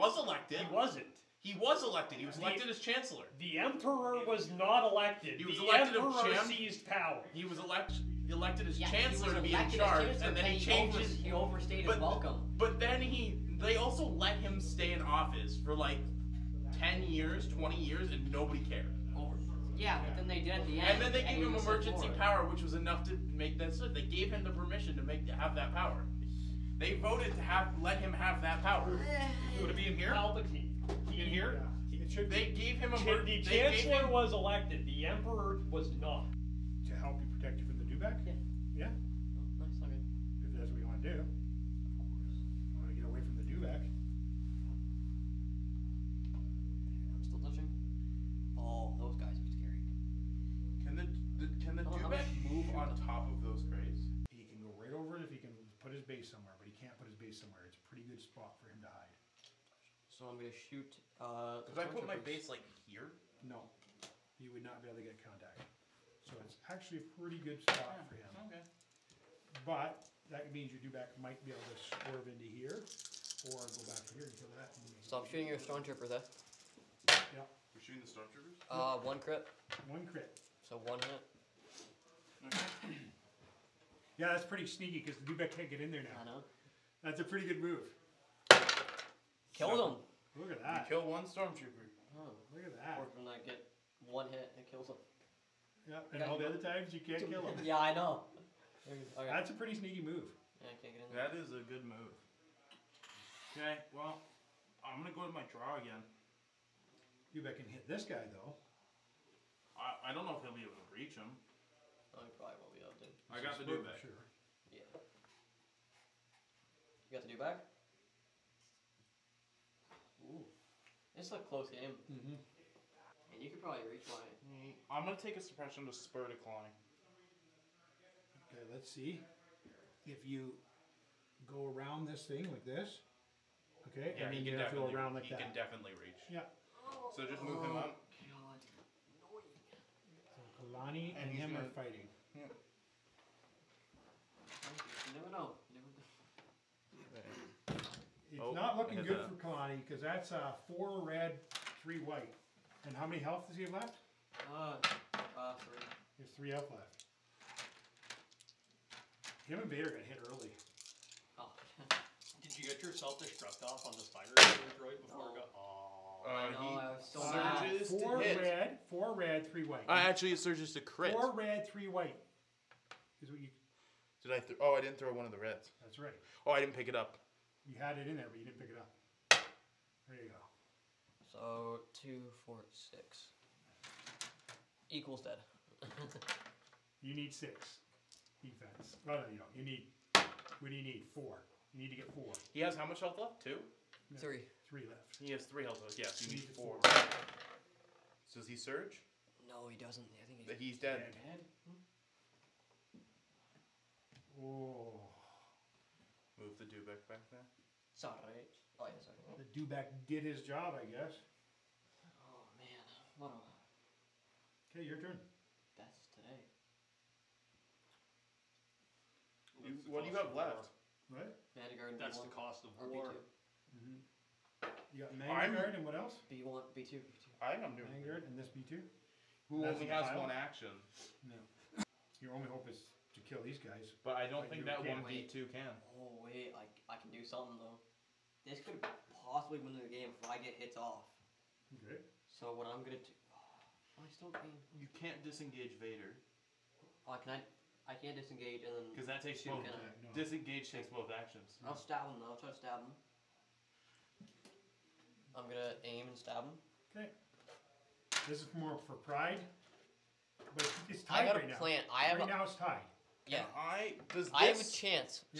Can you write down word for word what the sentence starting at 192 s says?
He has how much health left?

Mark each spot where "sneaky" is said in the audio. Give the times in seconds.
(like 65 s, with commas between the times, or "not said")
84 s, 99 s.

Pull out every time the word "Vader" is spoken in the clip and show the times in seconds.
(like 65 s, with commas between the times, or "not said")
159 s, 245 s.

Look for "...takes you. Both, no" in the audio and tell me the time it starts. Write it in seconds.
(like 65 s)
249 s.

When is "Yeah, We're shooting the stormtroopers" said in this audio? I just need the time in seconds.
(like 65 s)
77 s.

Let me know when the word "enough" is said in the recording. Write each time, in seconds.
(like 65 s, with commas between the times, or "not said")
22 s.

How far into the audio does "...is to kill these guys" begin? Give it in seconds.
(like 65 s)
232 s.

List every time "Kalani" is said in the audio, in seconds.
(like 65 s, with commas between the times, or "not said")
140 s, 149 s.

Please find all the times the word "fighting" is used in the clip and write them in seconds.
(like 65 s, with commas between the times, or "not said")
141 s.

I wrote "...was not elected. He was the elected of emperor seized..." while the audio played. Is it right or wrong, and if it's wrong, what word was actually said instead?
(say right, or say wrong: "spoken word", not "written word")
right.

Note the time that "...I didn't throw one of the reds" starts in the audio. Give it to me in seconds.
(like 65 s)
174 s.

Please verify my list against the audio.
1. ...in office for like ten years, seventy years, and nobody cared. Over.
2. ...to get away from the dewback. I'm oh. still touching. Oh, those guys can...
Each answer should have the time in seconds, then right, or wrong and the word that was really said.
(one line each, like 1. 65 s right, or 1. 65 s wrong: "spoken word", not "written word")
1. 14 s wrong: "twenty", not "seventy"
2. 42 s right.